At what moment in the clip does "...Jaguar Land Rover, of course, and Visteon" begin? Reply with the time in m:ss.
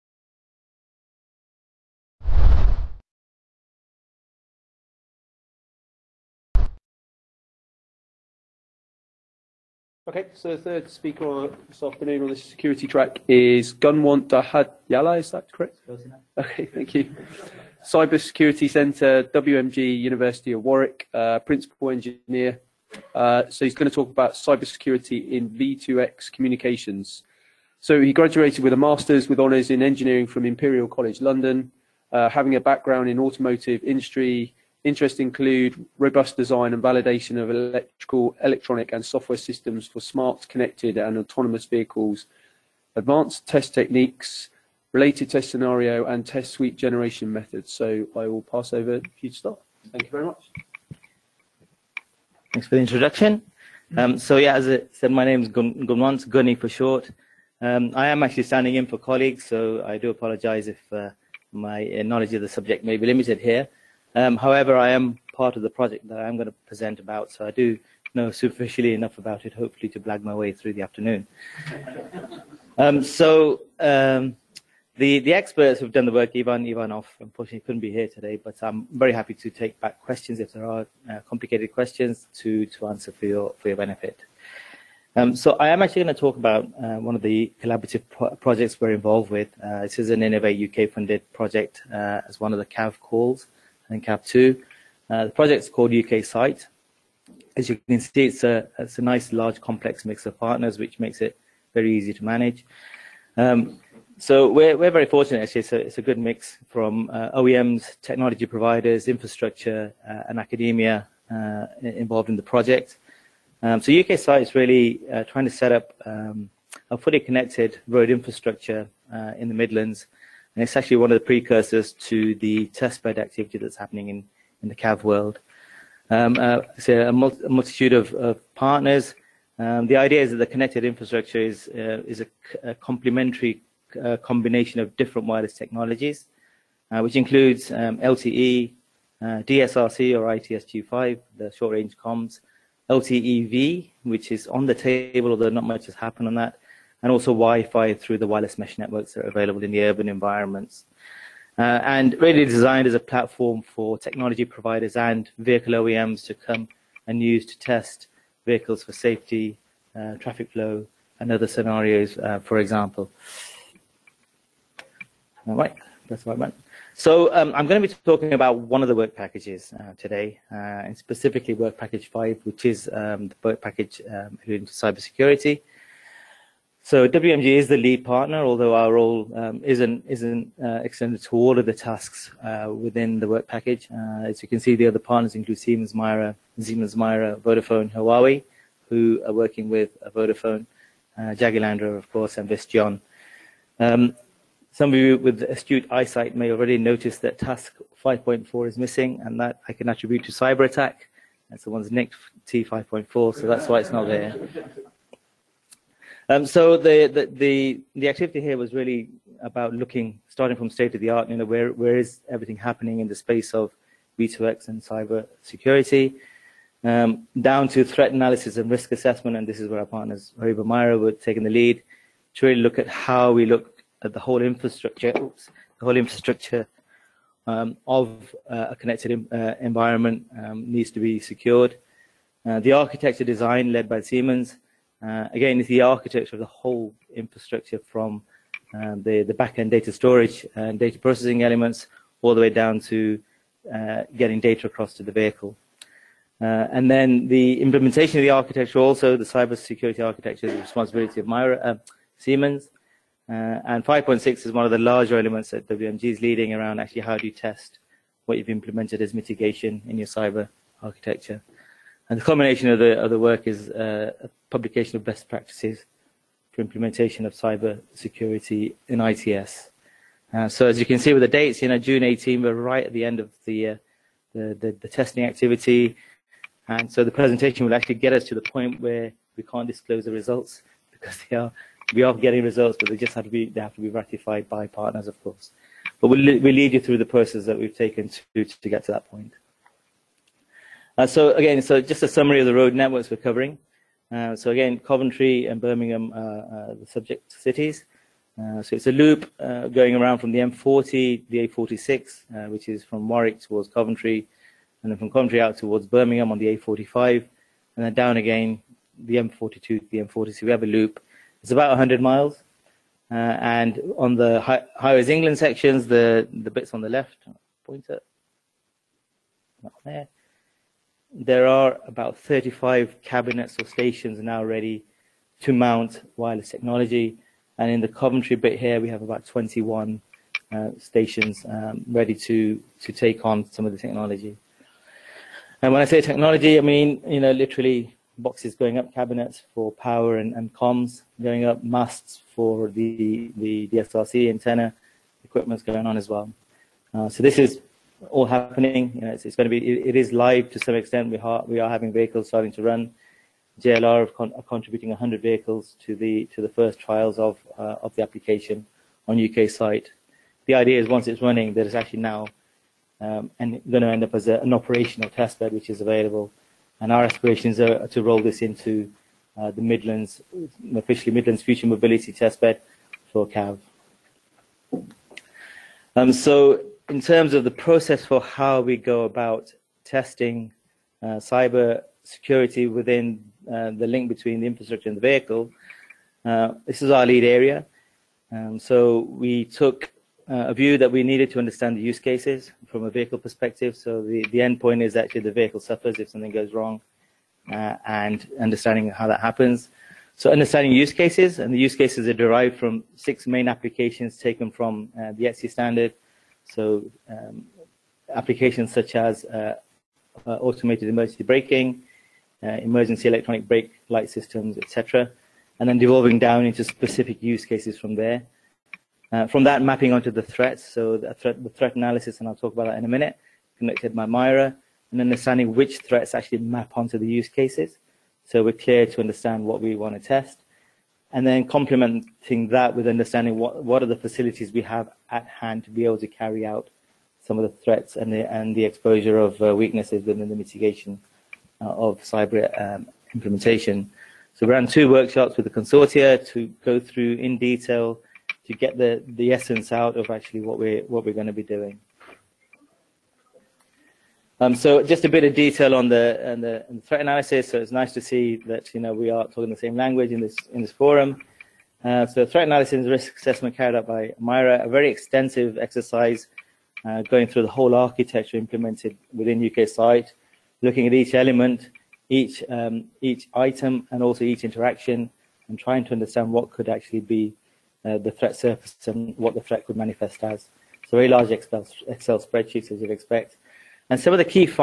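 3:11.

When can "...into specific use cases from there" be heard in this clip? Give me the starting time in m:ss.
6:56.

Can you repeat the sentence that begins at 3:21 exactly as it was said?
That's the one's nicked T5.4, so that's why it's not there.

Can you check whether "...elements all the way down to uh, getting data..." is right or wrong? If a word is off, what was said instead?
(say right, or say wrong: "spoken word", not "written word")
right.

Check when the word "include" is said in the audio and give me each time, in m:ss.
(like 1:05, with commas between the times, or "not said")
0:35, 2:17, 3:05.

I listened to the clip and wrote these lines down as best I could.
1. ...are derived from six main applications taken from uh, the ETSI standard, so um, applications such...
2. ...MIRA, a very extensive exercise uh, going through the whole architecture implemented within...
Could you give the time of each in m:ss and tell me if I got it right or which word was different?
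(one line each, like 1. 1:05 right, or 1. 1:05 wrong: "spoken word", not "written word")
1. 6:42 right
2. 7:44 right.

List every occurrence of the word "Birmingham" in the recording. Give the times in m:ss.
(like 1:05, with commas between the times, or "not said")
4:55, 5:05.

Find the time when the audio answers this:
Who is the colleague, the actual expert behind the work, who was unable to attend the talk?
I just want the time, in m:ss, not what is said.
1:16.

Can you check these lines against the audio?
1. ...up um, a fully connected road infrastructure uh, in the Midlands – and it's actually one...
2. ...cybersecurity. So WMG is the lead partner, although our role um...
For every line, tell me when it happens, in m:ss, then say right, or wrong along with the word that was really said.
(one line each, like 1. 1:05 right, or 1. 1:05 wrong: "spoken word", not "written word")
1. 1:55 right
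2. 2:54 right.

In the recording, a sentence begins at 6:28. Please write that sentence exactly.
Um, so we took uh, a view that we needed to understand the use cases from a vehicle perspective.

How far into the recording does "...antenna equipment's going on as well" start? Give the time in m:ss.
5:44.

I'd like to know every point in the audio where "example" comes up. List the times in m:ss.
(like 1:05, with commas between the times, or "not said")
2:42.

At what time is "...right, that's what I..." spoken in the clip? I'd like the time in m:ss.
2:45.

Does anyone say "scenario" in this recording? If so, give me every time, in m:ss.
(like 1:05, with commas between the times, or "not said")
0:45, 2:41.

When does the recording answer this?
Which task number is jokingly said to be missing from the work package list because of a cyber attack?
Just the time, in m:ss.
3:18.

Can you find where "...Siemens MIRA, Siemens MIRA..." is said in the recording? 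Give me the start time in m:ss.
3:05.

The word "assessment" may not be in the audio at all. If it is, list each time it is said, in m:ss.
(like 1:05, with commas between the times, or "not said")
3:38, 7:43.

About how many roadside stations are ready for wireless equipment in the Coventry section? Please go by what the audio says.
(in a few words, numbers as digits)
21.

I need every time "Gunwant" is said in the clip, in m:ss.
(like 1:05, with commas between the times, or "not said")
0:13, 0:55.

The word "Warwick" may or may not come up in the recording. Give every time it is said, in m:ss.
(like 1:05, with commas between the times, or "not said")
0:20, 5:03.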